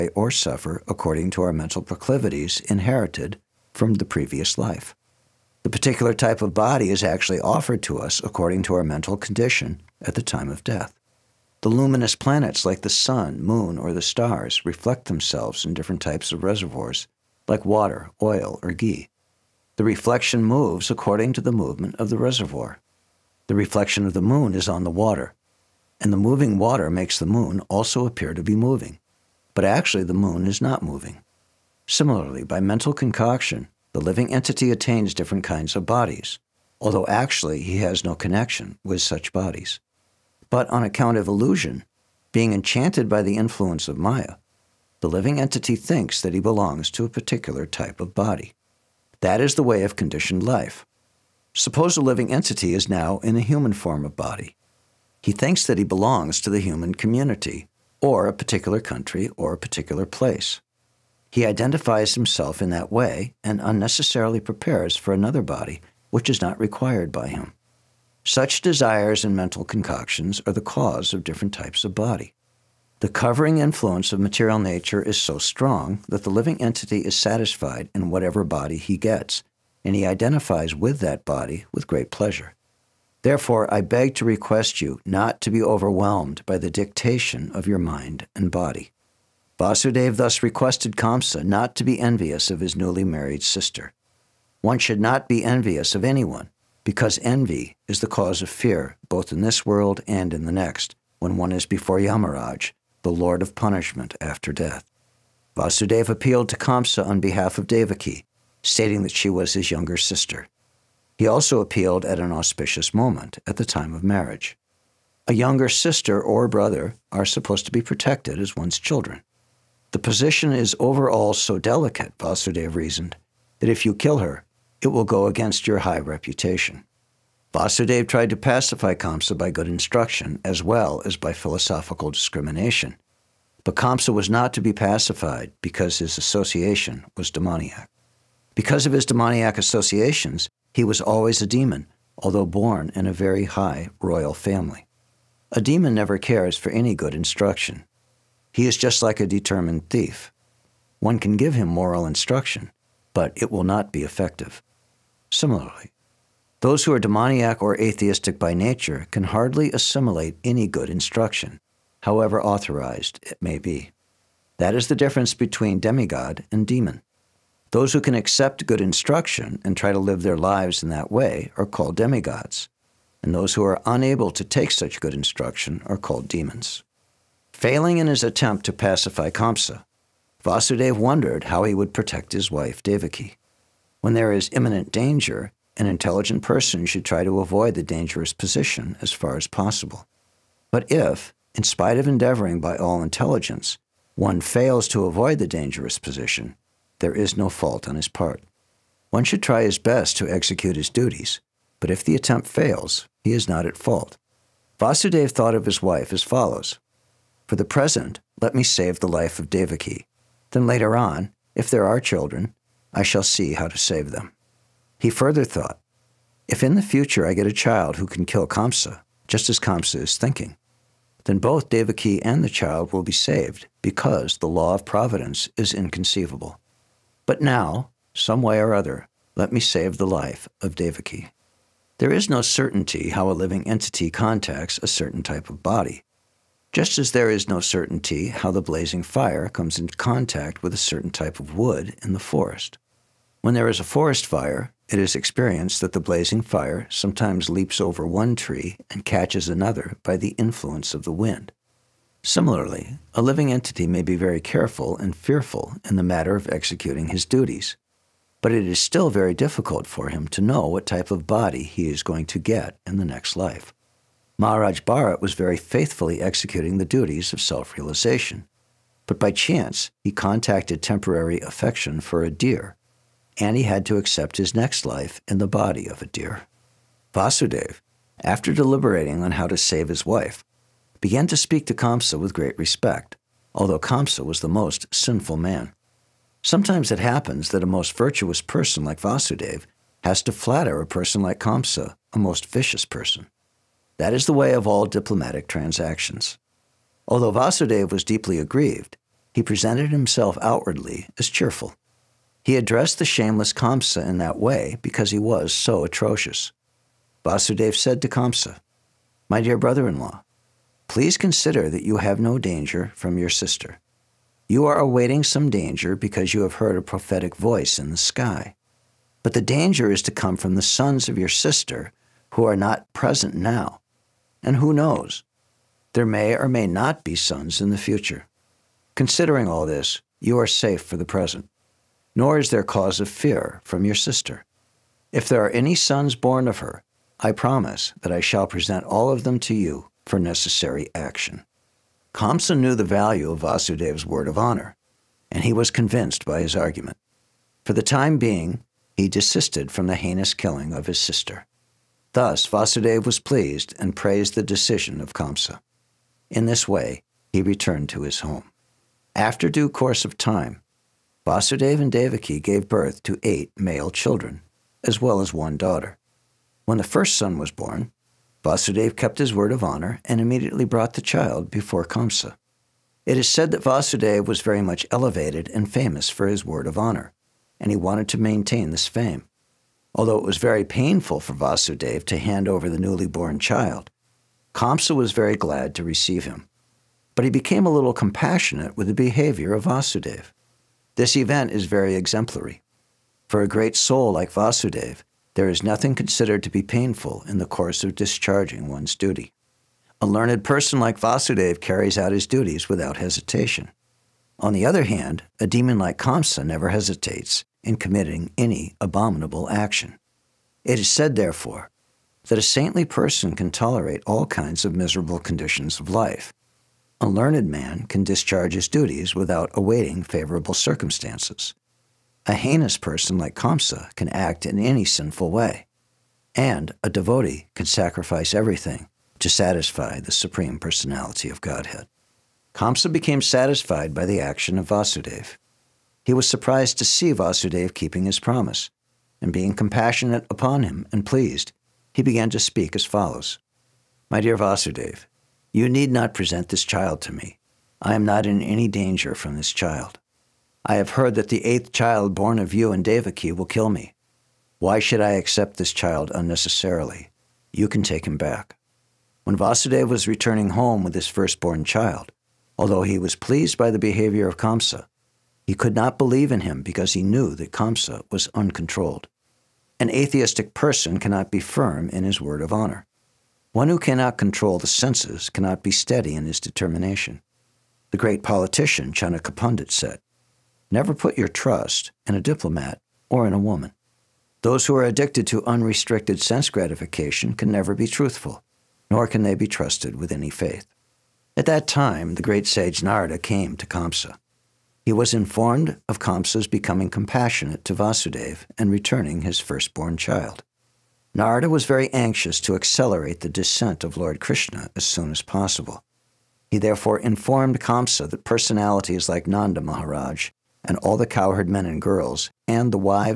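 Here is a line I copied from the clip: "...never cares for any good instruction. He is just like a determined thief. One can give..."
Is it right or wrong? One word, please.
right.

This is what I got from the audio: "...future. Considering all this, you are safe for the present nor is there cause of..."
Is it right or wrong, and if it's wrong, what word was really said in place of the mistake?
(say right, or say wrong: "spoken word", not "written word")
right.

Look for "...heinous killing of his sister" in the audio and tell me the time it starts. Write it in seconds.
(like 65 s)
349 s.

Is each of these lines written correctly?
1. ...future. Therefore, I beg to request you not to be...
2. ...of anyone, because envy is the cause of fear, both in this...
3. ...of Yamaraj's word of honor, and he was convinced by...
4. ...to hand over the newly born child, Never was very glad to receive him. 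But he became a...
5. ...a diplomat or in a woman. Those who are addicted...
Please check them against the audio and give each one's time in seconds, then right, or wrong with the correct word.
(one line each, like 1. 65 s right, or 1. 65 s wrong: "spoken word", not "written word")
1. 82 s wrong: "pleasure", not "future"
2. 95 s right
3. 343 s wrong: "Vasudeva", not "Yamaraj"
4. 382 s wrong: "Kamsa", not "Never"
5. 482 s right.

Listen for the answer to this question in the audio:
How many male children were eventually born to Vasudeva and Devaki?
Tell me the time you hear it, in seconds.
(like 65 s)
363 s.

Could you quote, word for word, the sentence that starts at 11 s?
The luminous planets like the sun, moon, or the stars reflect themselves in different types of reservoirs, like water, oil, or ghee.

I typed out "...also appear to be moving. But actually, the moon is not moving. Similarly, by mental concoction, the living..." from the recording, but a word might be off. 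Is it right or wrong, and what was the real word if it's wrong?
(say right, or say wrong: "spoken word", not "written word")
right.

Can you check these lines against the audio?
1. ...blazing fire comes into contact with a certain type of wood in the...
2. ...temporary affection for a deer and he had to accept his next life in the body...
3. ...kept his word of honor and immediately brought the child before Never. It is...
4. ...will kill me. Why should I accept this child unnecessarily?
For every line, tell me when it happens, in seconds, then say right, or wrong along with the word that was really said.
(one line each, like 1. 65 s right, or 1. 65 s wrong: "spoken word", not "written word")
1. 238 s right
2. 270 s right
3. 368 s wrong: "Kamsa", not "Never"
4. 453 s right.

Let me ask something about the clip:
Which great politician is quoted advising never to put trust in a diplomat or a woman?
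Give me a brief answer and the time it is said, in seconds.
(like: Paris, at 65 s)
Chanakya Pandit, at 478 s.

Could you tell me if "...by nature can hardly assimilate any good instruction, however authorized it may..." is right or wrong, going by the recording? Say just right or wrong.
right.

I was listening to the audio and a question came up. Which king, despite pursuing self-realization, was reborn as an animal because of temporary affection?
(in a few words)
Maharaj Bharat.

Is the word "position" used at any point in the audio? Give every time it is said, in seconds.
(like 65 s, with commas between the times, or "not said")
119 s, 188 s, 195 s.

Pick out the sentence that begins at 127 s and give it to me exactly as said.
Vasudev tried to pacify Kamsa by good instruction as well as by philosophical discrimination.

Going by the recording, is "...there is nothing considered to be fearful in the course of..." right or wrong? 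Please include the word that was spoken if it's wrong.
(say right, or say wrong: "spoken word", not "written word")
wrong: "painful", not "fearful".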